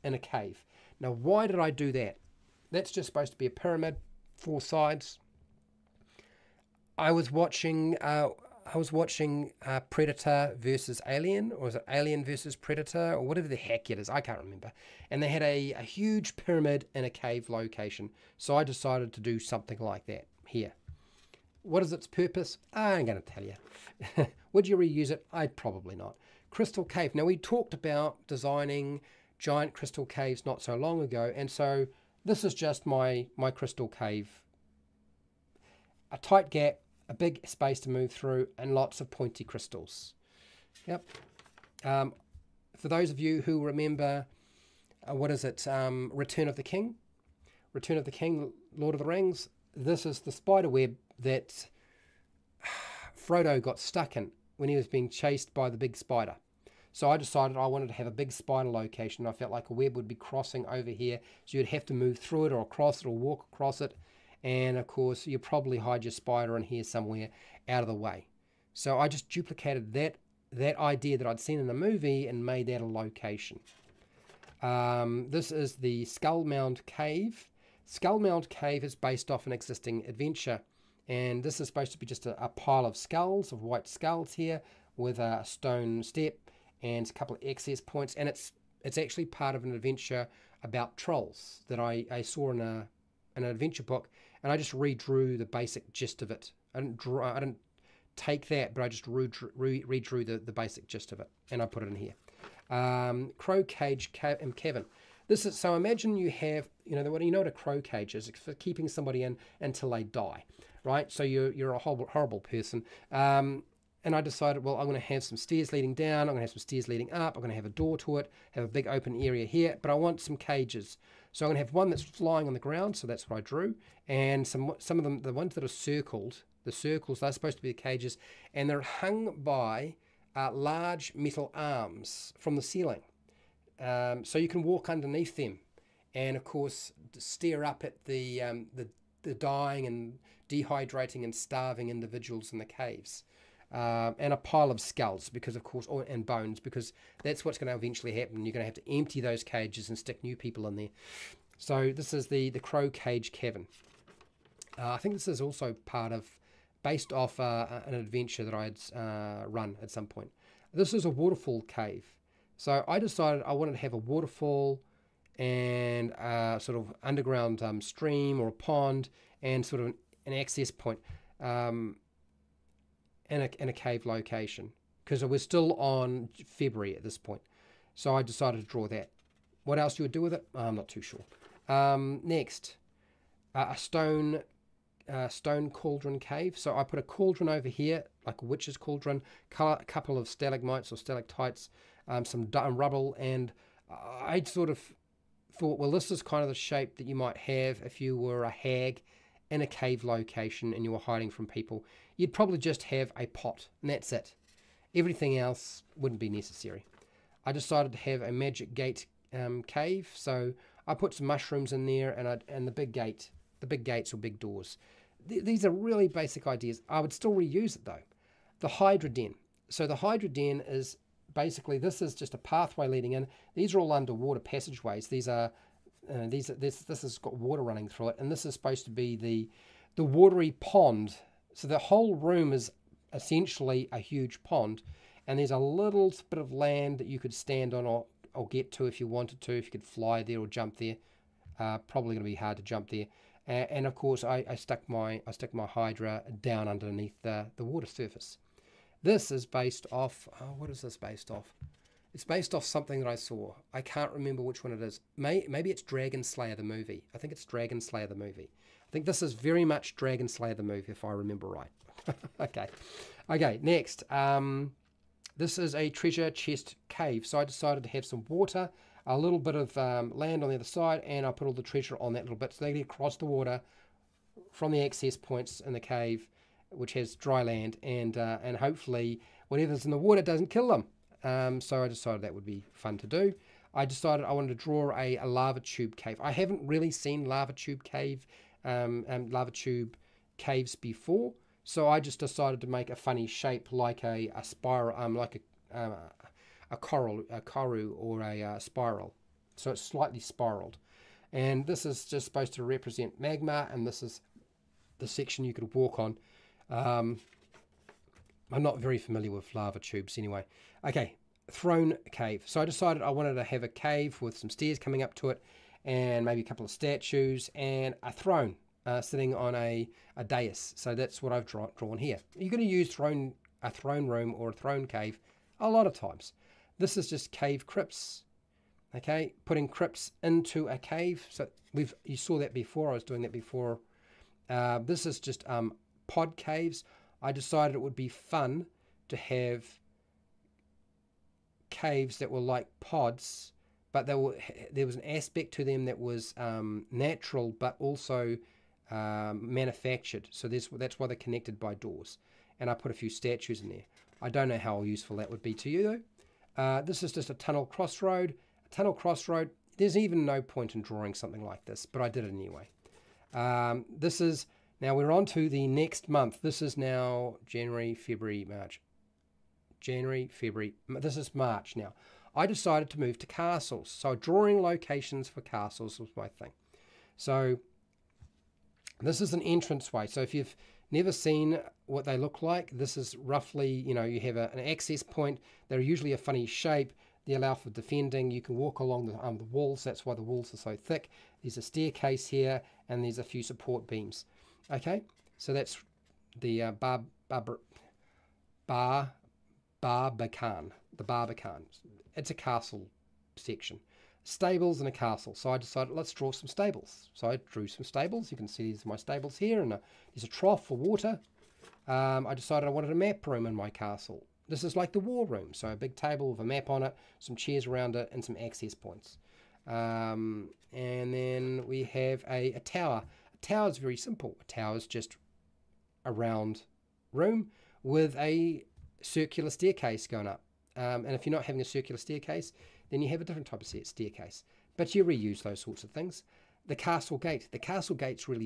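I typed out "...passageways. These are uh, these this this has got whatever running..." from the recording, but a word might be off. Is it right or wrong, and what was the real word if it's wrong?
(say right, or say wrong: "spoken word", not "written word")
wrong: "water", not "whatever".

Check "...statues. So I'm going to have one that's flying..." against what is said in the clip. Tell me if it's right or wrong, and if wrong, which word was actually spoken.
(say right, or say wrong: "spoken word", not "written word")
wrong: "cages", not "statues".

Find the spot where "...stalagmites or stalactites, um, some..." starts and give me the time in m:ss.
3:10.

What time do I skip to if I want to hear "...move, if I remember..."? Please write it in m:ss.
4:20.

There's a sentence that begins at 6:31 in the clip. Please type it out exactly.
There's a staircase here and there's a few support beams.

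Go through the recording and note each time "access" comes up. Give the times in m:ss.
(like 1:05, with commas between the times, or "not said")
1:27, 2:50, 4:34, 6:24, 6:58.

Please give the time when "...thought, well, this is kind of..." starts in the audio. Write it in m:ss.
3:15.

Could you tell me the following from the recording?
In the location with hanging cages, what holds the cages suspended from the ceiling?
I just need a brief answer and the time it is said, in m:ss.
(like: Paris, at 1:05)
large metal arms, at 2:10.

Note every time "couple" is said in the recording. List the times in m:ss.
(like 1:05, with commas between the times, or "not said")
1:27, 3:09, 5:16.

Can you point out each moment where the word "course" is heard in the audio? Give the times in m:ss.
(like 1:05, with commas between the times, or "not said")
1:04, 2:16, 2:25, 4:03.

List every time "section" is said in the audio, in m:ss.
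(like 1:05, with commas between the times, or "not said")
5:05, 6:43.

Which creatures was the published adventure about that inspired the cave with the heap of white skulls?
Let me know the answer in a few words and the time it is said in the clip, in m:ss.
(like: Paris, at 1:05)
trolls, at 1:30.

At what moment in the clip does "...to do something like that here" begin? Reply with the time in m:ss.
0:19.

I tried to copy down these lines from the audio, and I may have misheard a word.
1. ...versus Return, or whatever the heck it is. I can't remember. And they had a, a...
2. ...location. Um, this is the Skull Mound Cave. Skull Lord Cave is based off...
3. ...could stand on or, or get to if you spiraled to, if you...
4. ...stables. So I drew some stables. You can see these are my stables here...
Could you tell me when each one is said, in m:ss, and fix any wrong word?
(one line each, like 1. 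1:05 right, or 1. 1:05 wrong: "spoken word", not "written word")
1. 0:12 wrong: "Predator", not "Return"
2. 1:12 wrong: "Mound", not "Lord"
3. 3:57 wrong: "wanted", not "spiraled"
4. 6:46 right.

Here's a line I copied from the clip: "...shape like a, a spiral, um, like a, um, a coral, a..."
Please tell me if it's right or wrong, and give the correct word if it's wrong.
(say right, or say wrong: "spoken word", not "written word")
right.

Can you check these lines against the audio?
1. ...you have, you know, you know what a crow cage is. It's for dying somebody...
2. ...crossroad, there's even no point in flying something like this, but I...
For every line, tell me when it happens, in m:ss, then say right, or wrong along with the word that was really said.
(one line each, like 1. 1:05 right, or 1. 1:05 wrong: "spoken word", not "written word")
1. 1:46 wrong: "keeping", not "dying"
2. 5:58 wrong: "drawing", not "flying".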